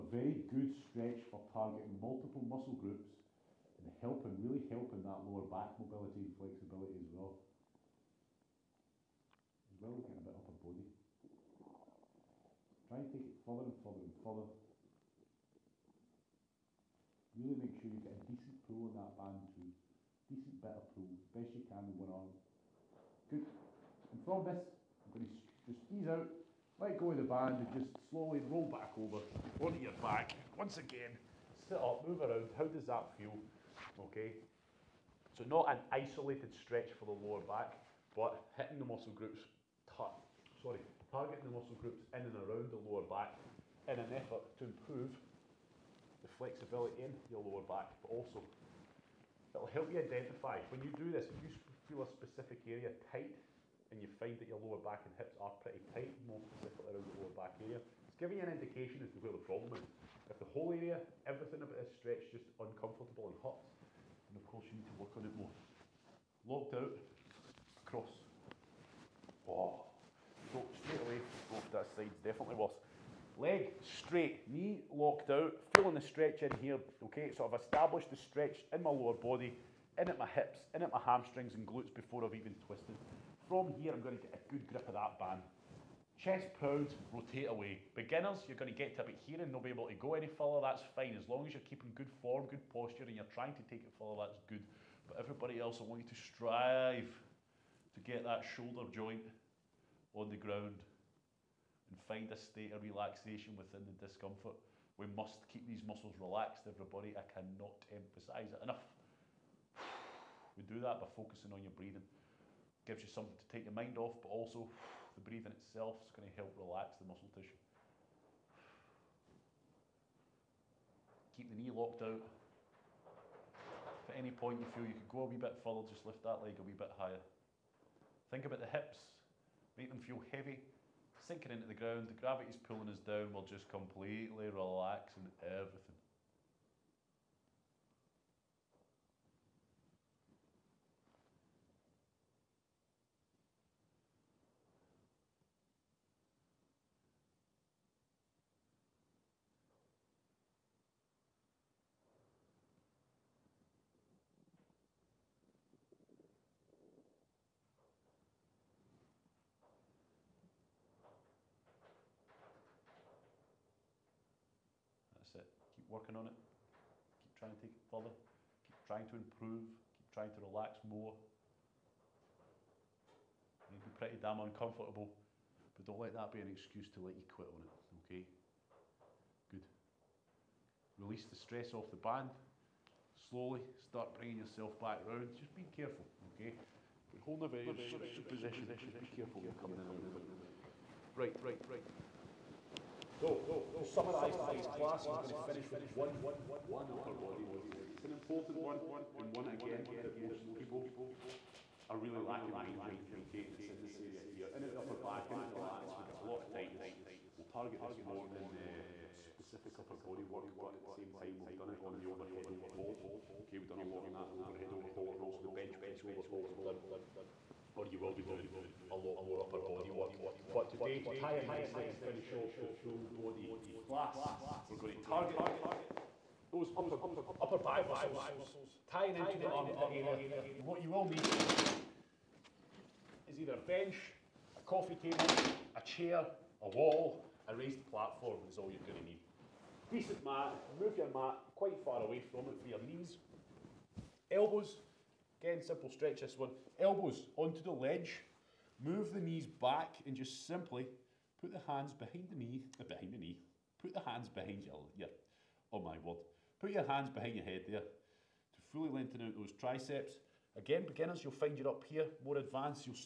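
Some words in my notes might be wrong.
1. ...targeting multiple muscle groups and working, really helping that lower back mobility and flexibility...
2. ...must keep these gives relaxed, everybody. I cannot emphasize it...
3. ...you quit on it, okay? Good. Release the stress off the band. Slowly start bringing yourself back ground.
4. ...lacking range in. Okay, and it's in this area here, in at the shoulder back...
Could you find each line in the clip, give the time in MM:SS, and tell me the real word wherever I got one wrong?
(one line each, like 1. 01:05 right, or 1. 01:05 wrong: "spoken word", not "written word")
1. 00:01 wrong: "helping", not "working"
2. 01:45 wrong: "muscles", not "gives"
3. 02:57 wrong: "round", not "ground"
4. 03:22 wrong: "upper", not "shoulder".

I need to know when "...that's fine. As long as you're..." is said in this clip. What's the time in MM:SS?
01:30.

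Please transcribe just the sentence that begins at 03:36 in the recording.
We've done, or you will be doing a lot more upper body work.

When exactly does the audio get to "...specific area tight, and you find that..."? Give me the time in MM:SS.
00:52.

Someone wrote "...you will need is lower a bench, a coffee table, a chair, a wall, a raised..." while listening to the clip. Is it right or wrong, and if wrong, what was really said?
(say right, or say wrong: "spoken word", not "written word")
wrong: "either", not "lower".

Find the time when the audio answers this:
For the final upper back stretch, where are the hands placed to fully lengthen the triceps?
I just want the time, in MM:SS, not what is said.
04:17.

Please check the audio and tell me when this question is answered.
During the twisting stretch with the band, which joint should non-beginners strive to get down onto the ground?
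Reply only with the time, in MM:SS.
01:38.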